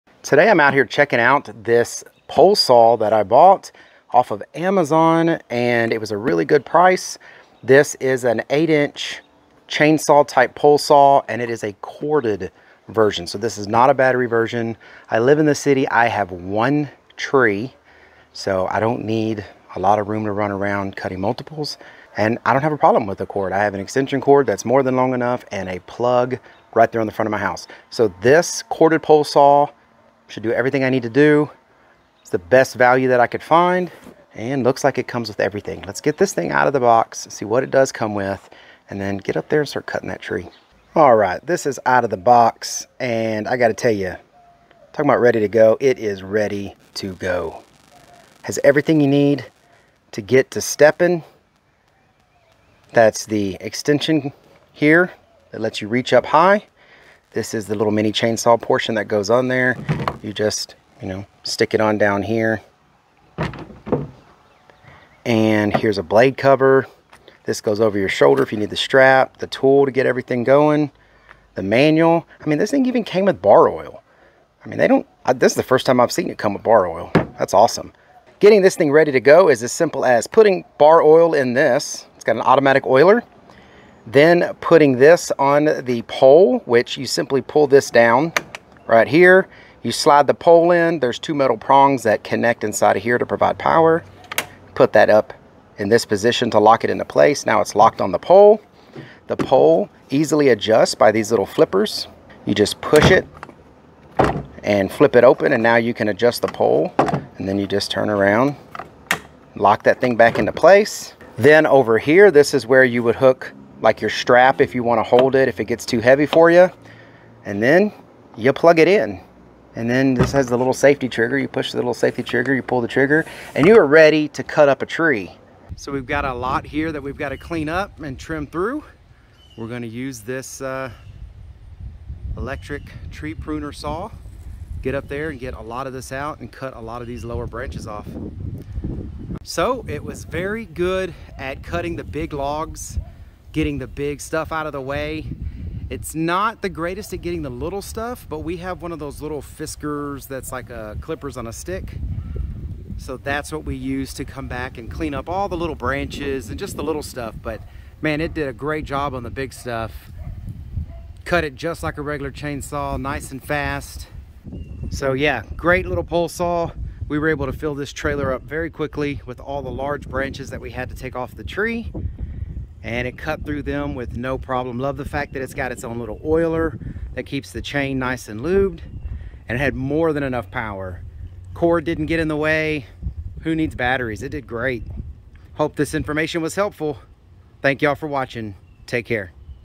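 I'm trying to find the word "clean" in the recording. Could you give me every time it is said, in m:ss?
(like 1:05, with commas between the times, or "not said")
2:07, 2:34.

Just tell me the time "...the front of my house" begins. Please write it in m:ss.
0:27.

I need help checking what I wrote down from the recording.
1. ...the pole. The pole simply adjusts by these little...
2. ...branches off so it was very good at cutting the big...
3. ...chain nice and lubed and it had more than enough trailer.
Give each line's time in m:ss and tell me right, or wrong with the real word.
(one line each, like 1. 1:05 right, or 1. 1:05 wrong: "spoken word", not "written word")
1. 1:38 wrong: "easily", not "simply"
2. 2:17 right
3. 2:57 wrong: "power", not "trailer".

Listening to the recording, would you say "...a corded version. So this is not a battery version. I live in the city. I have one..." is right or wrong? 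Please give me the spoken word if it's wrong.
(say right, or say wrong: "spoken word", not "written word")
right.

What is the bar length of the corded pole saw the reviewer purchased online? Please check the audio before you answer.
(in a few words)
8 inch.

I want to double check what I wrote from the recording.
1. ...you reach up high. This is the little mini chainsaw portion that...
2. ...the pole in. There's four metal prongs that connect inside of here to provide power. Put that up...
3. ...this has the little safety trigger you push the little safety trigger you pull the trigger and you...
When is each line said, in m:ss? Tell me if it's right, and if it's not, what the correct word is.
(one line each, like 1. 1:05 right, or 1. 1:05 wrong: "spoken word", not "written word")
1. 0:55 right
2. 1:30 wrong: "two", not "four"
3. 2:00 right.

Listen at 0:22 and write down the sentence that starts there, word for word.
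And I don't have a problem with a cord.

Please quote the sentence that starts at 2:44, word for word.
So yeah, great little pole saw.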